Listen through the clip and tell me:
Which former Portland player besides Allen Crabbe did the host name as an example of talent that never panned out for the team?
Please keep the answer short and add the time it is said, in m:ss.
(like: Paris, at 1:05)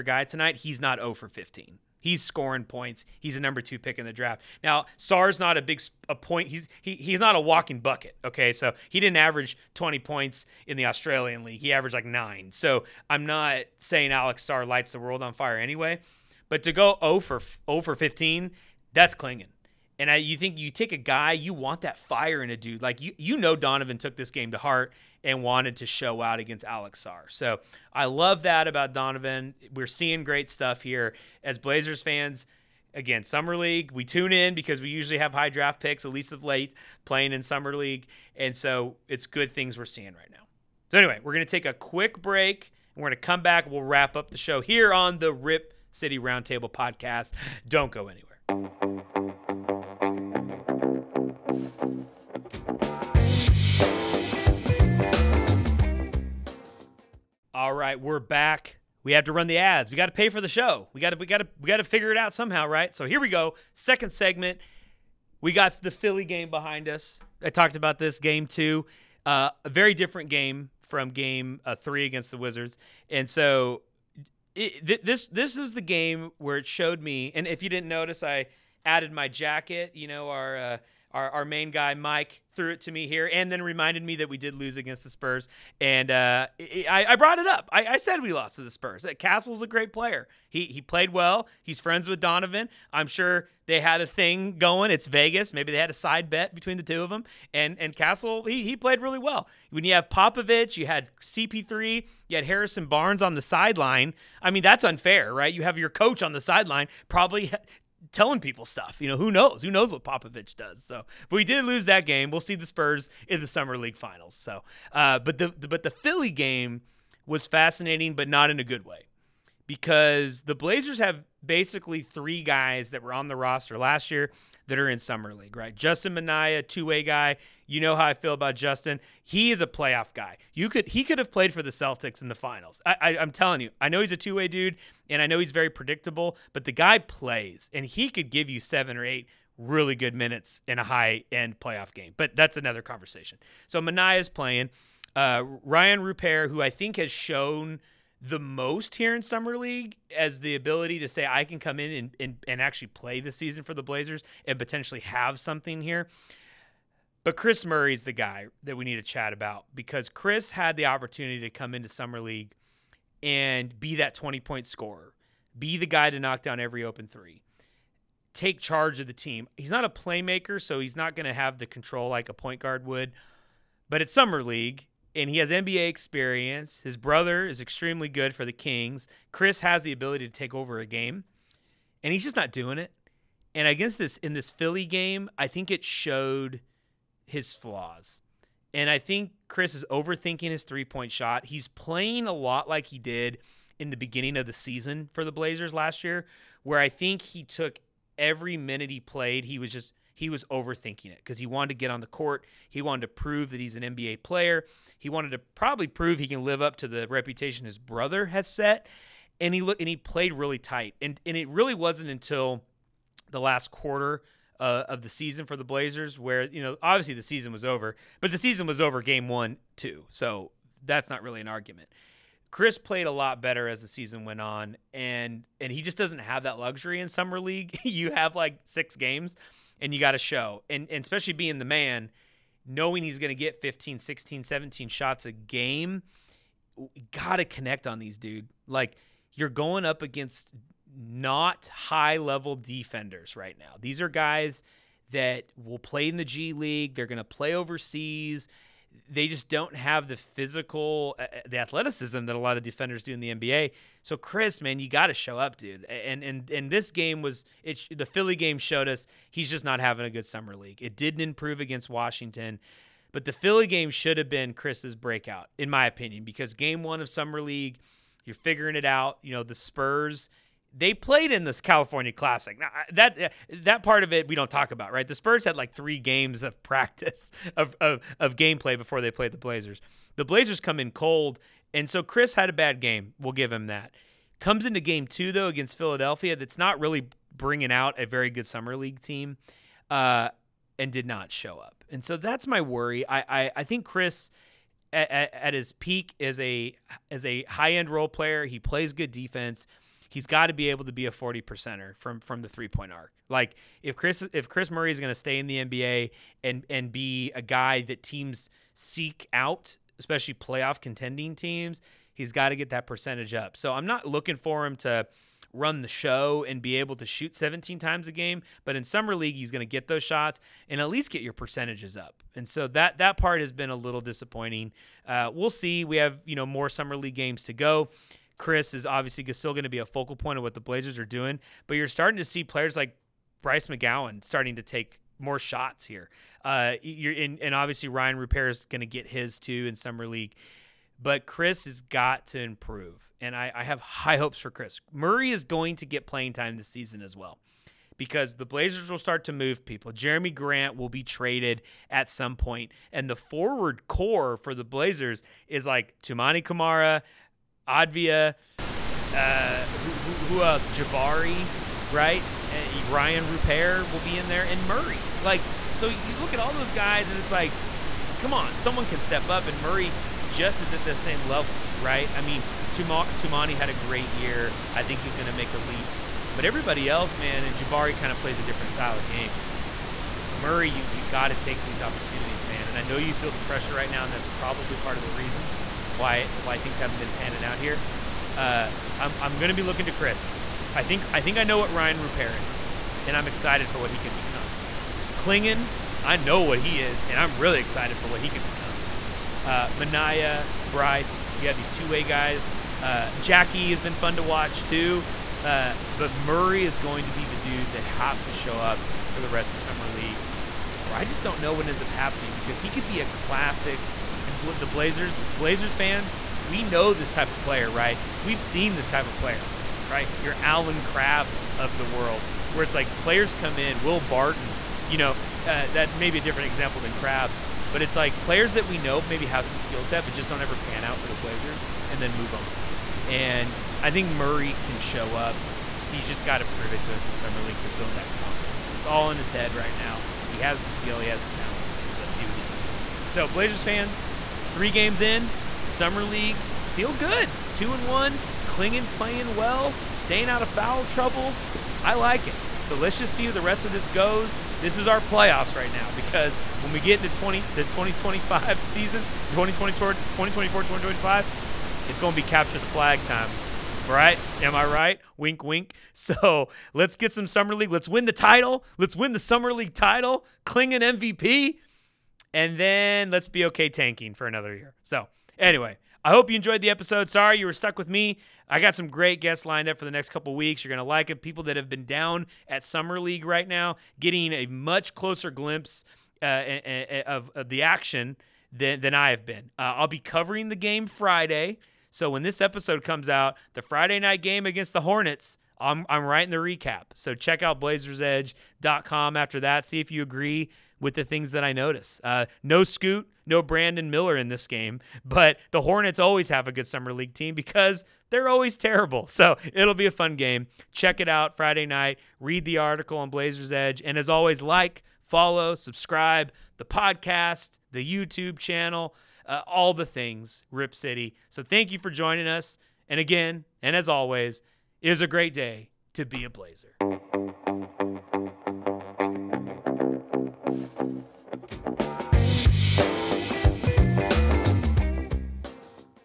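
Will Barton, at 7:03.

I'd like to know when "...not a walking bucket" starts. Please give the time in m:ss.
0:07.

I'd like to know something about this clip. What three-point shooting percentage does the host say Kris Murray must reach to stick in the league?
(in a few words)
40 percent.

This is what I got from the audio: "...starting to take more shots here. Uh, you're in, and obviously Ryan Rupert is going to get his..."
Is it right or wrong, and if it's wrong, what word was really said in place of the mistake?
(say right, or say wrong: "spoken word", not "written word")
right.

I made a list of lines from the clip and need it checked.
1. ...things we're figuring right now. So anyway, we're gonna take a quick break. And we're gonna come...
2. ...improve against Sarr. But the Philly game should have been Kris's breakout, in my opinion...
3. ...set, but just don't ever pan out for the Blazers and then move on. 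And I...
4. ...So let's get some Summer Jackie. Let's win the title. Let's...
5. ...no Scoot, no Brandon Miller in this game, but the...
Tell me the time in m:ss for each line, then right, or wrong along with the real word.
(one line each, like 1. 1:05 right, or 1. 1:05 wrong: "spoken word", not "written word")
1. 0:39 wrong: "seeing", not "figuring"
2. 4:21 wrong: "Washington", not "Sarr"
3. 7:09 right
4. 7:45 wrong: "League", not "Jackie"
5. 8:22 right.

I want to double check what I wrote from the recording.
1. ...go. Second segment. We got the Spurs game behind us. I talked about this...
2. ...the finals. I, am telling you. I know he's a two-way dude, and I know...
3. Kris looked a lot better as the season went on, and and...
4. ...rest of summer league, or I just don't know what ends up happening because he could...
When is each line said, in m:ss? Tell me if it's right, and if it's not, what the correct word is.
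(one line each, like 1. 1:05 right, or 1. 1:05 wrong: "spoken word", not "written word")
1. 1:03 wrong: "Philly", not "Spurs"
2. 2:12 right
3. 3:42 wrong: "played", not "looked"
4. 6:49 right.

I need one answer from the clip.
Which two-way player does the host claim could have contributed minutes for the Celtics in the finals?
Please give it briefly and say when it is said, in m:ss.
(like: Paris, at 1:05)
Justin Minaya, at 2:05.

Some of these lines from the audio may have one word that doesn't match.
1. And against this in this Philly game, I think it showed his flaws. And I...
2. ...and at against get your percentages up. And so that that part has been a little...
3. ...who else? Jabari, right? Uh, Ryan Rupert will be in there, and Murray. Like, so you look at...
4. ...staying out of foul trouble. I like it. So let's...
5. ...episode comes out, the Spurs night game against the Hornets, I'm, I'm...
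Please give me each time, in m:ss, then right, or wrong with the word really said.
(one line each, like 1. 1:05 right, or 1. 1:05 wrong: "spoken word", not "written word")
1. 3:03 right
2. 5:20 wrong: "least", not "against"
3. 6:00 right
4. 7:29 right
5. 8:12 wrong: "Friday", not "Spurs".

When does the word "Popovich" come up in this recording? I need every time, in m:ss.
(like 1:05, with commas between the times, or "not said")
1:40, 1:50.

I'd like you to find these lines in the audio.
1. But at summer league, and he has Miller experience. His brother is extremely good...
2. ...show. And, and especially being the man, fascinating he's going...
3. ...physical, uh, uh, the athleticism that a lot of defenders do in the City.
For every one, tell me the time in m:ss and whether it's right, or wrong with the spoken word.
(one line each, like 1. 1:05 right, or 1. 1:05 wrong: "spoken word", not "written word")
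1. 2:53 wrong: "NBA", not "Miller"
2. 3:50 wrong: "knowing", not "fascinating"
3. 4:10 wrong: "NBA", not "City".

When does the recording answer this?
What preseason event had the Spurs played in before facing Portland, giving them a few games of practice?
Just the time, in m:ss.
4:31.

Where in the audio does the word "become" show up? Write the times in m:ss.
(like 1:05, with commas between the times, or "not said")
6:34, 6:38.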